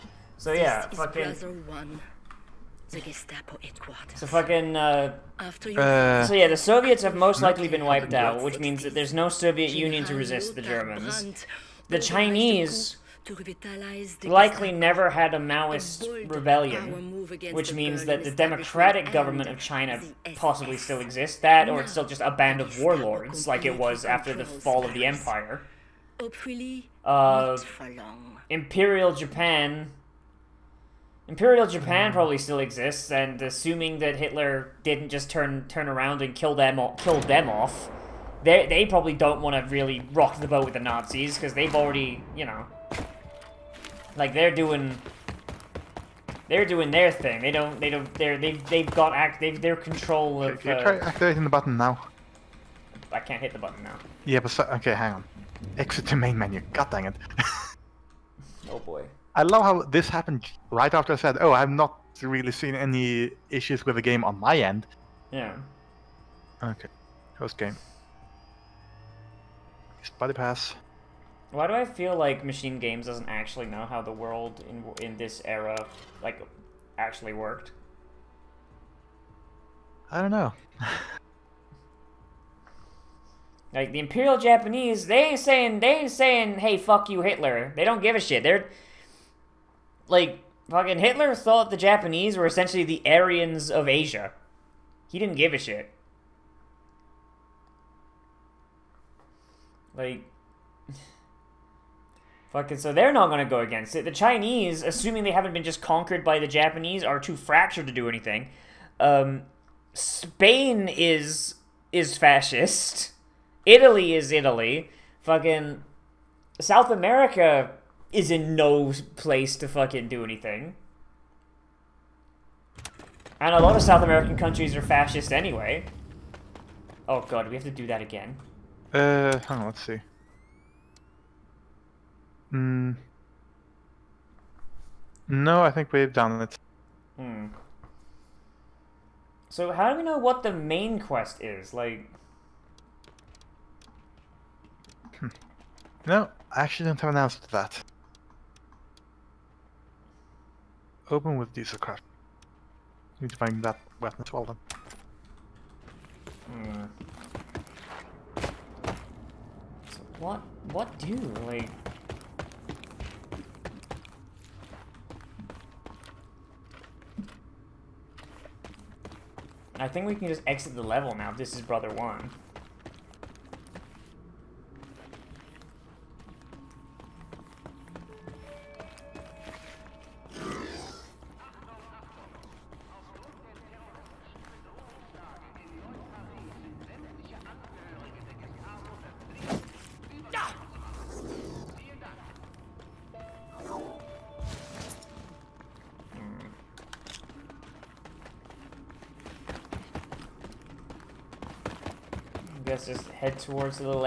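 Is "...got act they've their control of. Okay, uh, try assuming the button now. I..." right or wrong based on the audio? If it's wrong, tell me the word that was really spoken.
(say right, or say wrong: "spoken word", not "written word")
wrong: "activating", not "assuming".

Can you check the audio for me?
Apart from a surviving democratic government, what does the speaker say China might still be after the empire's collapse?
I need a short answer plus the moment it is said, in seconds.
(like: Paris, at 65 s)
A band of warlords, at 22 s.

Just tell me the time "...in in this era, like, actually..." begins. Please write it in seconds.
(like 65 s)
74 s.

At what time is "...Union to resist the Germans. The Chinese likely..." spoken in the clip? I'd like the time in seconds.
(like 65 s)
9 s.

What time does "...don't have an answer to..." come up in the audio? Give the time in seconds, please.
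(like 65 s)
146 s.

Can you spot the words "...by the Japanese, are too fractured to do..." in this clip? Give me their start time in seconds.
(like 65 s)
106 s.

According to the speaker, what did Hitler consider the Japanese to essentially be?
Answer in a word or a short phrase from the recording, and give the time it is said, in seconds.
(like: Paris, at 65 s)
The Aryans of Asia, at 93 s.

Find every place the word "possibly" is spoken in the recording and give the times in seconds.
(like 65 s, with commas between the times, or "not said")
20 s.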